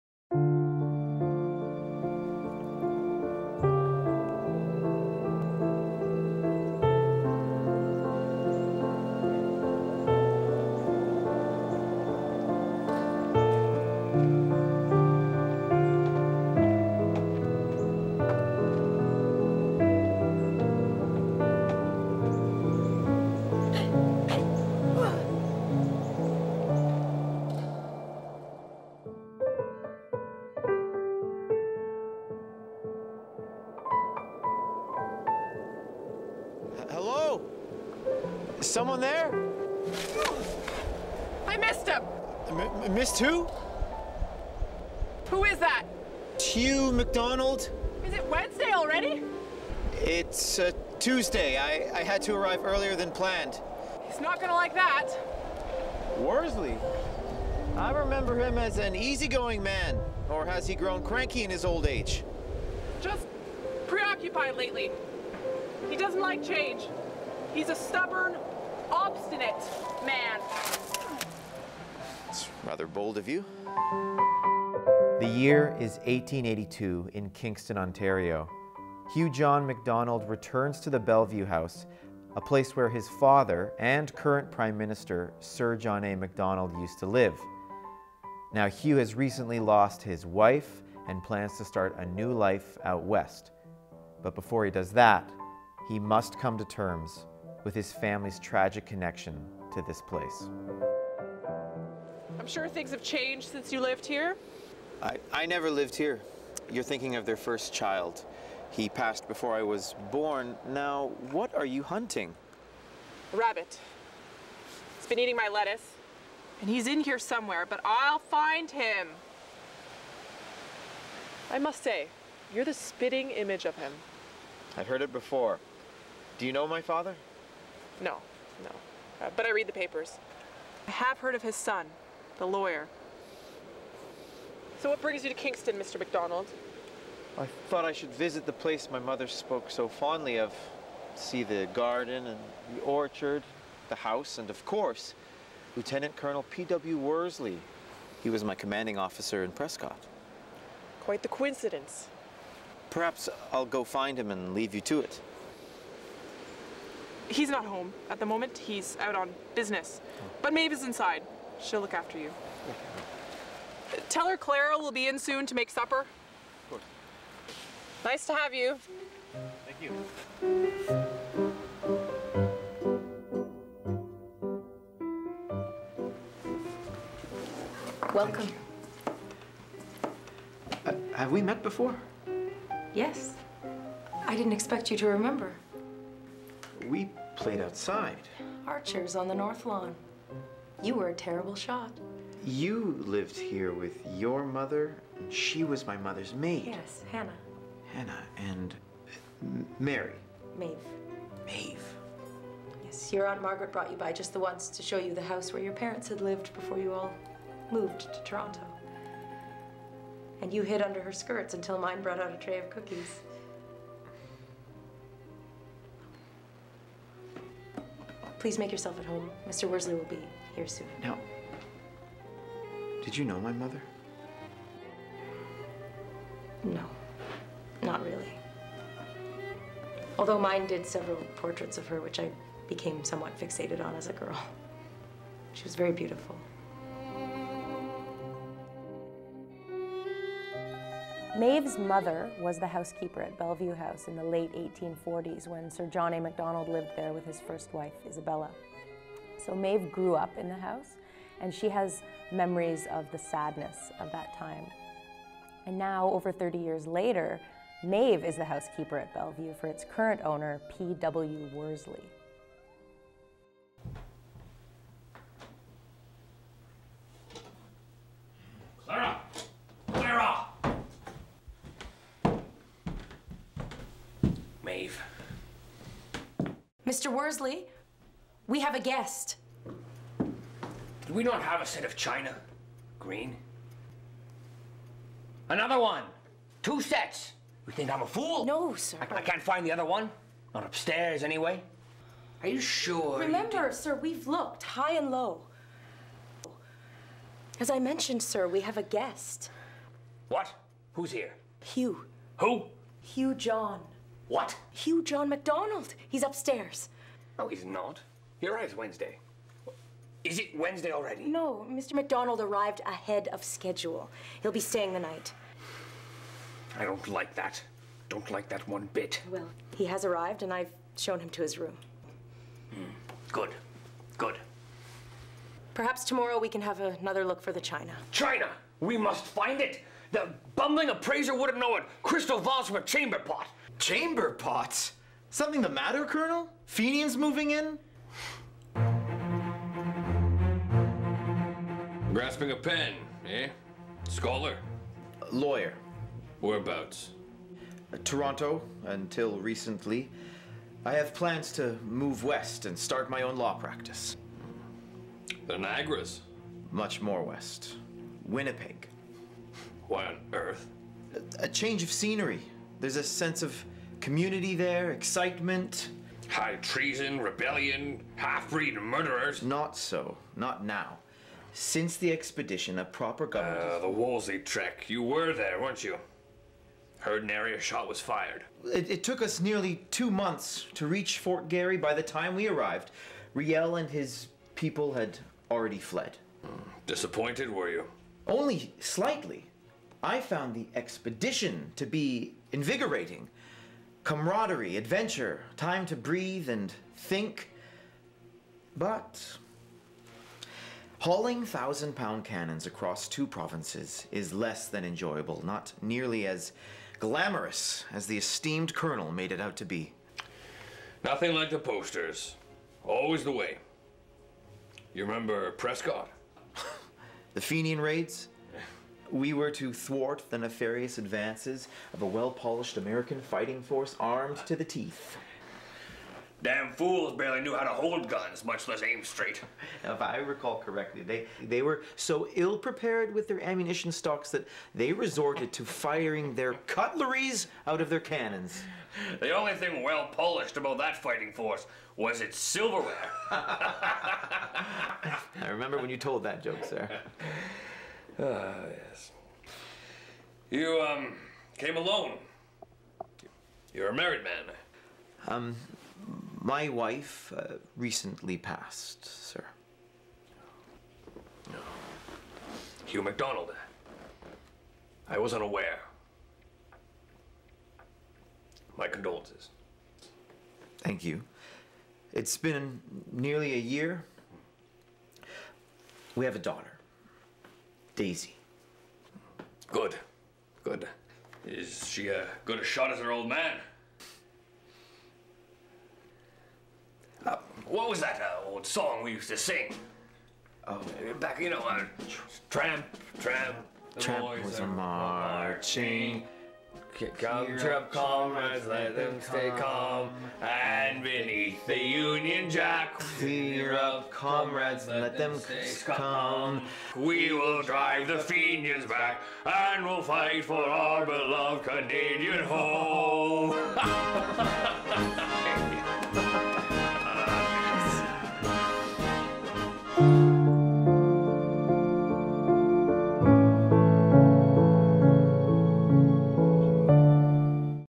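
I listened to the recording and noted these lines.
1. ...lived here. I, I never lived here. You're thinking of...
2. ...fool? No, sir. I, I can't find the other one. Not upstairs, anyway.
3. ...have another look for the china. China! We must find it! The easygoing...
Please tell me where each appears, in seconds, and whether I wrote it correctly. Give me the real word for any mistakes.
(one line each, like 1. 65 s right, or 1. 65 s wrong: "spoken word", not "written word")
1. 103 s right
2. 288 s right
3. 326 s wrong: "bumbling", not "easygoing".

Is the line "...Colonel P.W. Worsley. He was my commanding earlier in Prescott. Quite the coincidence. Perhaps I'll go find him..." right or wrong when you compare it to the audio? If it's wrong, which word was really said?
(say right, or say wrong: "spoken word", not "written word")
wrong: "officer", not "earlier".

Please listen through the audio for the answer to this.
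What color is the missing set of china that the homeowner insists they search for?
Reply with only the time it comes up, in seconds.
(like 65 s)
282 s.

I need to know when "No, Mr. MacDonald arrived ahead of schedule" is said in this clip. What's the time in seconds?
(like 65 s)
311 s.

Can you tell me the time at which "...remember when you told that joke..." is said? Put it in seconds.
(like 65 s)
445 s.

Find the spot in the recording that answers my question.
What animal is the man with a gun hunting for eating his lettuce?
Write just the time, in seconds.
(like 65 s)
113 s.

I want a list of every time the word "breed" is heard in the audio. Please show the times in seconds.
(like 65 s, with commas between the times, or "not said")
368 s.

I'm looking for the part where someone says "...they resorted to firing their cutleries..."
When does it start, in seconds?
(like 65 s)
434 s.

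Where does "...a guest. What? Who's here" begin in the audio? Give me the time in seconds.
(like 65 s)
298 s.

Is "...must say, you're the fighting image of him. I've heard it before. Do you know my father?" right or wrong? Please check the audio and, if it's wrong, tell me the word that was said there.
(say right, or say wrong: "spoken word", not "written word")
wrong: "spitting", not "fighting".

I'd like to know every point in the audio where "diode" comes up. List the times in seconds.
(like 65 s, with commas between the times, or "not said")
not said.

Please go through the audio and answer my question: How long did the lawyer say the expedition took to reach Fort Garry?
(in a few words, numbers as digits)
nearly two months.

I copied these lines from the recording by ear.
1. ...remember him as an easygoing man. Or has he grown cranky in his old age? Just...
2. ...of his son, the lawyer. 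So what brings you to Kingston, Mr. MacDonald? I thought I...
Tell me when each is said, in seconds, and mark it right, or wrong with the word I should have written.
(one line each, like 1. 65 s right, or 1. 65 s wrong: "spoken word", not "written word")
1. 57 s right
2. 131 s right.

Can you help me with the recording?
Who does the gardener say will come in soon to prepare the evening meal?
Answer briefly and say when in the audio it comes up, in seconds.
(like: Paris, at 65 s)
Clara, at 164 s.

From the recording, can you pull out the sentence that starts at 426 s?
Damn fools barely knew how to hold guns, much less aim straight.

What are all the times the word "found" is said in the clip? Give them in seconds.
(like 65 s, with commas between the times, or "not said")
390 s.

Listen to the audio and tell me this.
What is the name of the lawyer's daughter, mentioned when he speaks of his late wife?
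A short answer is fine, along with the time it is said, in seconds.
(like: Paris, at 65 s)
Daisy, at 478 s.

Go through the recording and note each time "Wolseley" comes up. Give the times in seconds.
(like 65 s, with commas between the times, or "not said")
373 s.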